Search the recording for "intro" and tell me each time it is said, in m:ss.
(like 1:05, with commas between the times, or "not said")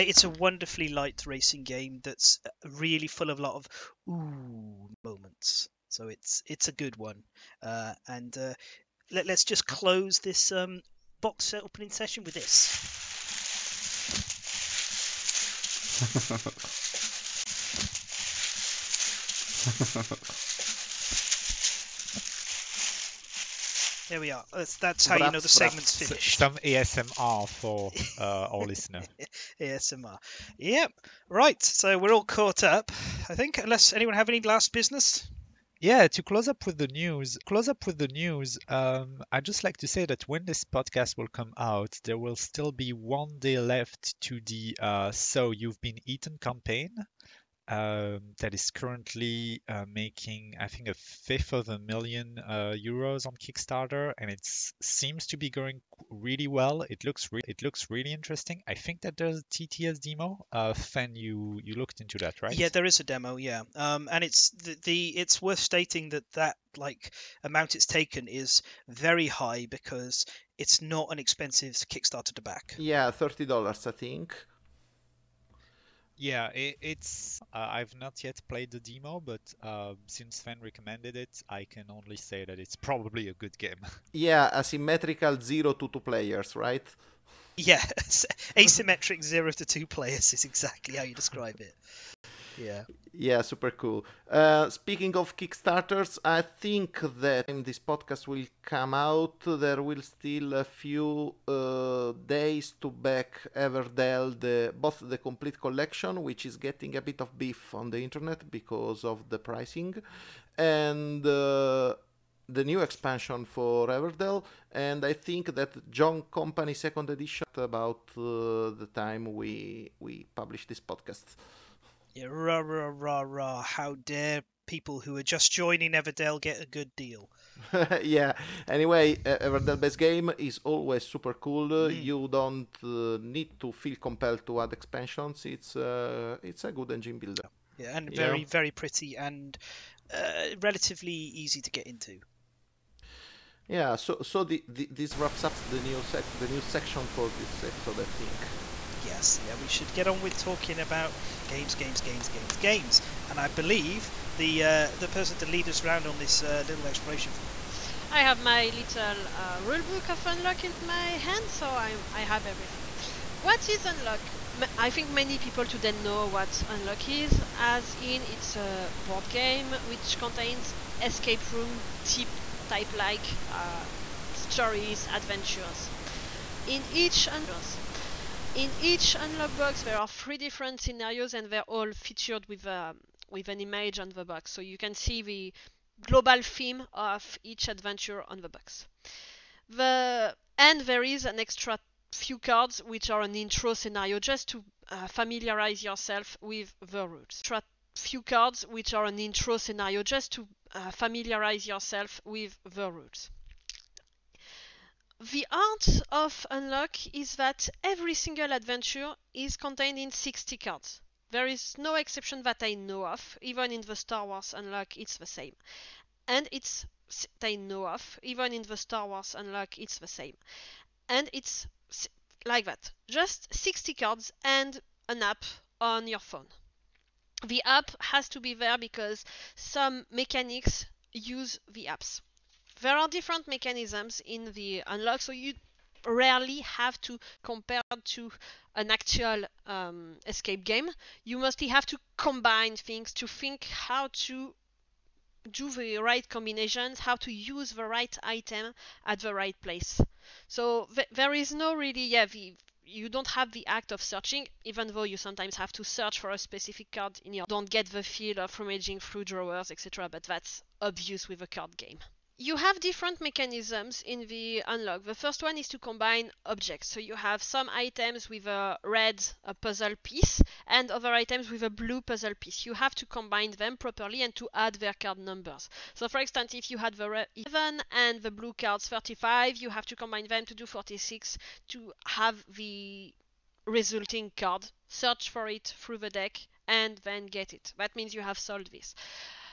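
3:13, 3:19.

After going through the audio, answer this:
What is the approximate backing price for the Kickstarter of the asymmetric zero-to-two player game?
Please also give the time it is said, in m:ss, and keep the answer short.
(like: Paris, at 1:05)
30 dollars, at 1:13.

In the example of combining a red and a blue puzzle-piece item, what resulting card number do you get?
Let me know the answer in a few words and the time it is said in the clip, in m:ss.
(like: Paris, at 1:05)
46, at 4:40.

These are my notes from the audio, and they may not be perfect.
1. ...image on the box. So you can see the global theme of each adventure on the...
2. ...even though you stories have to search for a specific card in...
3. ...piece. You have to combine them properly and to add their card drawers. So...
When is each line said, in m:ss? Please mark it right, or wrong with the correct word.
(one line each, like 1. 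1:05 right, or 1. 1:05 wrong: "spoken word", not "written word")
1. 3:03 right
2. 4:14 wrong: "sometimes", not "stories"
3. 4:32 wrong: "numbers", not "drawers".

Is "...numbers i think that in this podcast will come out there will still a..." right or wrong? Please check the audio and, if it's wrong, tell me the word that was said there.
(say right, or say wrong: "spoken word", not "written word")
wrong: "kickstarters", not "numbers".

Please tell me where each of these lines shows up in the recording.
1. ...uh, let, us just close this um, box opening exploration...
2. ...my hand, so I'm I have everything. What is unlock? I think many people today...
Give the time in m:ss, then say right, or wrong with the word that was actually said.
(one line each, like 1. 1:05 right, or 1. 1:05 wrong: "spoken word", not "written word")
1. 0:08 wrong: "session", not "exploration"
2. 2:40 right.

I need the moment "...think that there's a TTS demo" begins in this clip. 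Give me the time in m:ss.
0:58.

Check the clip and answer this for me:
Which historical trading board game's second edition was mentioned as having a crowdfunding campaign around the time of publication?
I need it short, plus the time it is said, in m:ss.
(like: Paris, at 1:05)
John Company, at 1:55.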